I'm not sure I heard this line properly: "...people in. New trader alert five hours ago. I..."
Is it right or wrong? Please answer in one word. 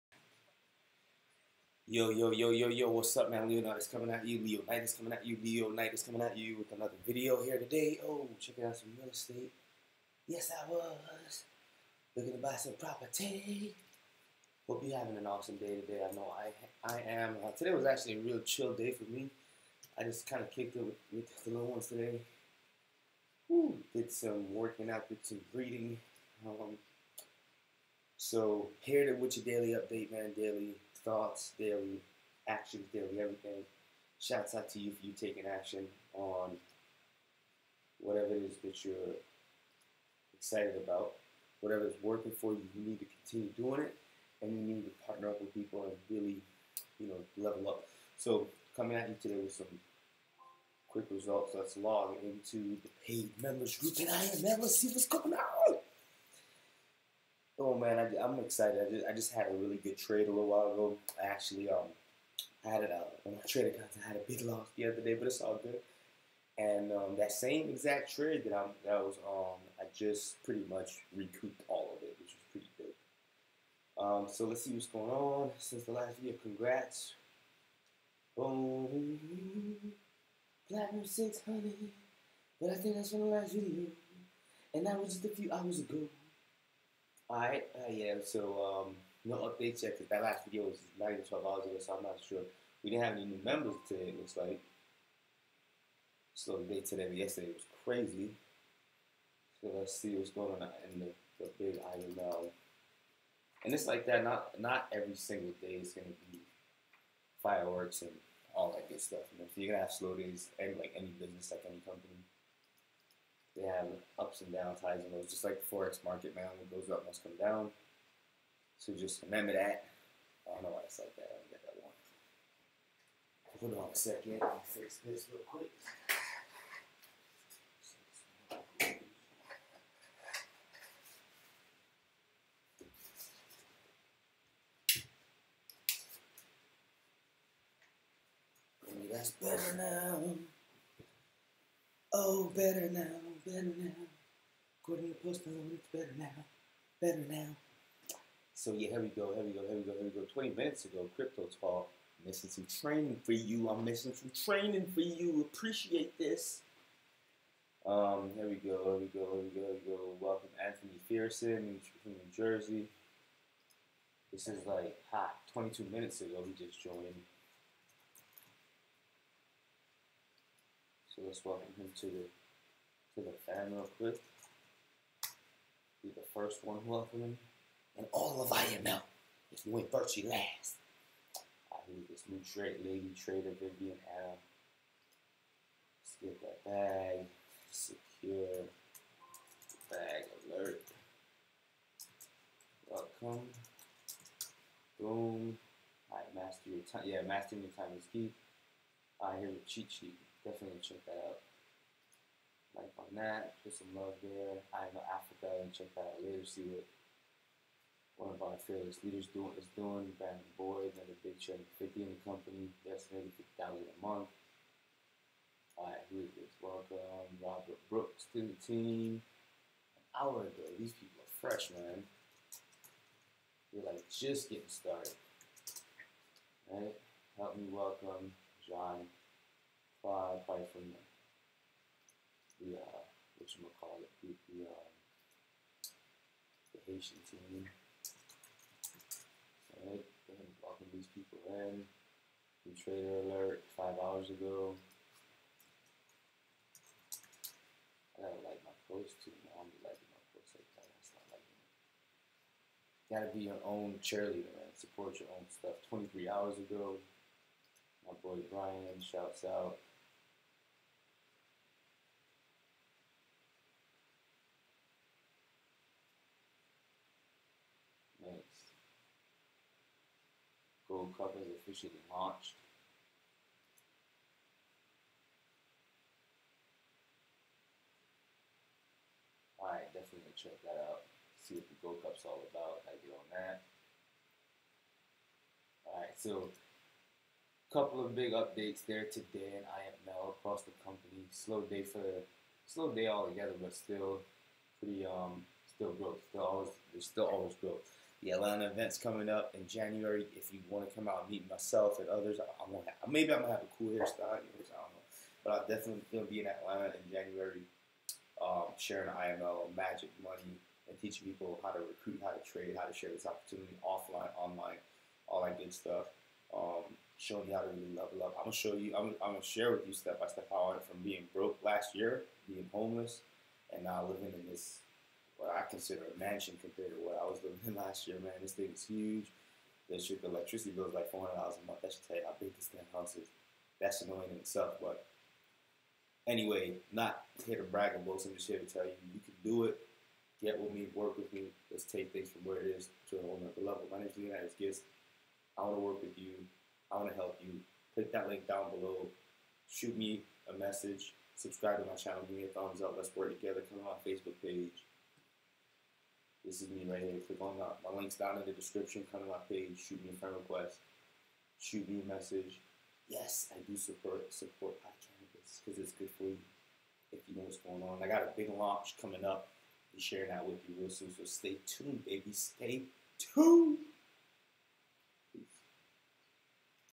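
right.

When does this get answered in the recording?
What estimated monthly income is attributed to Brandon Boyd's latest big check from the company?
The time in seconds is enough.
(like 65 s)
213 s.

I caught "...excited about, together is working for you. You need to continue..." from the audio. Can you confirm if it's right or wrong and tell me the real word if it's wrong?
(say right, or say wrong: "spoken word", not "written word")
wrong: "whatever", not "together".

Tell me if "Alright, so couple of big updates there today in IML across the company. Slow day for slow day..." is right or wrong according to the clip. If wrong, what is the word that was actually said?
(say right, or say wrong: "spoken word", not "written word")
right.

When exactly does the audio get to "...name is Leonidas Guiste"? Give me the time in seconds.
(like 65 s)
343 s.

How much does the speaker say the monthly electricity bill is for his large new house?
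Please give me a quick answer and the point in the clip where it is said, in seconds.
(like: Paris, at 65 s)
$400, at 331 s.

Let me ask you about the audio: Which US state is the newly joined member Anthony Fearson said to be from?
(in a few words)
New Jersey.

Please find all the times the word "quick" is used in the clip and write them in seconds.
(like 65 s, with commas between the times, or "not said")
50 s, 125 s, 173 s.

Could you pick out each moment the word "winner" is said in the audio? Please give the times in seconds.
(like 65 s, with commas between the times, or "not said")
not said.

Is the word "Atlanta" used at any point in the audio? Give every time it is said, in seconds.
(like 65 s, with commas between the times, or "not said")
298 s, 306 s.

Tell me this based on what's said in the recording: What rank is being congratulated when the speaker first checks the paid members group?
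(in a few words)
Platinum 600.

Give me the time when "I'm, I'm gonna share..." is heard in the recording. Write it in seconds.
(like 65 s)
318 s.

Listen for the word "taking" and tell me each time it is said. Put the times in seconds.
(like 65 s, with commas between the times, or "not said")
35 s.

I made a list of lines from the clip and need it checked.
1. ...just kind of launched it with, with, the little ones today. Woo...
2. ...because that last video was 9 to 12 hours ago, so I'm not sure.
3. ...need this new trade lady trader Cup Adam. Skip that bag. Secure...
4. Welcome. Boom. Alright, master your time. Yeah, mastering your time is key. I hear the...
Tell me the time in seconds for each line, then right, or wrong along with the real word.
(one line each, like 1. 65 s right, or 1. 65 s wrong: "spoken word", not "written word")
1. 20 s wrong: "kicked", not "launched"
2. 89 s right
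3. 181 s wrong: "Vivian", not "Cup"
4. 192 s right.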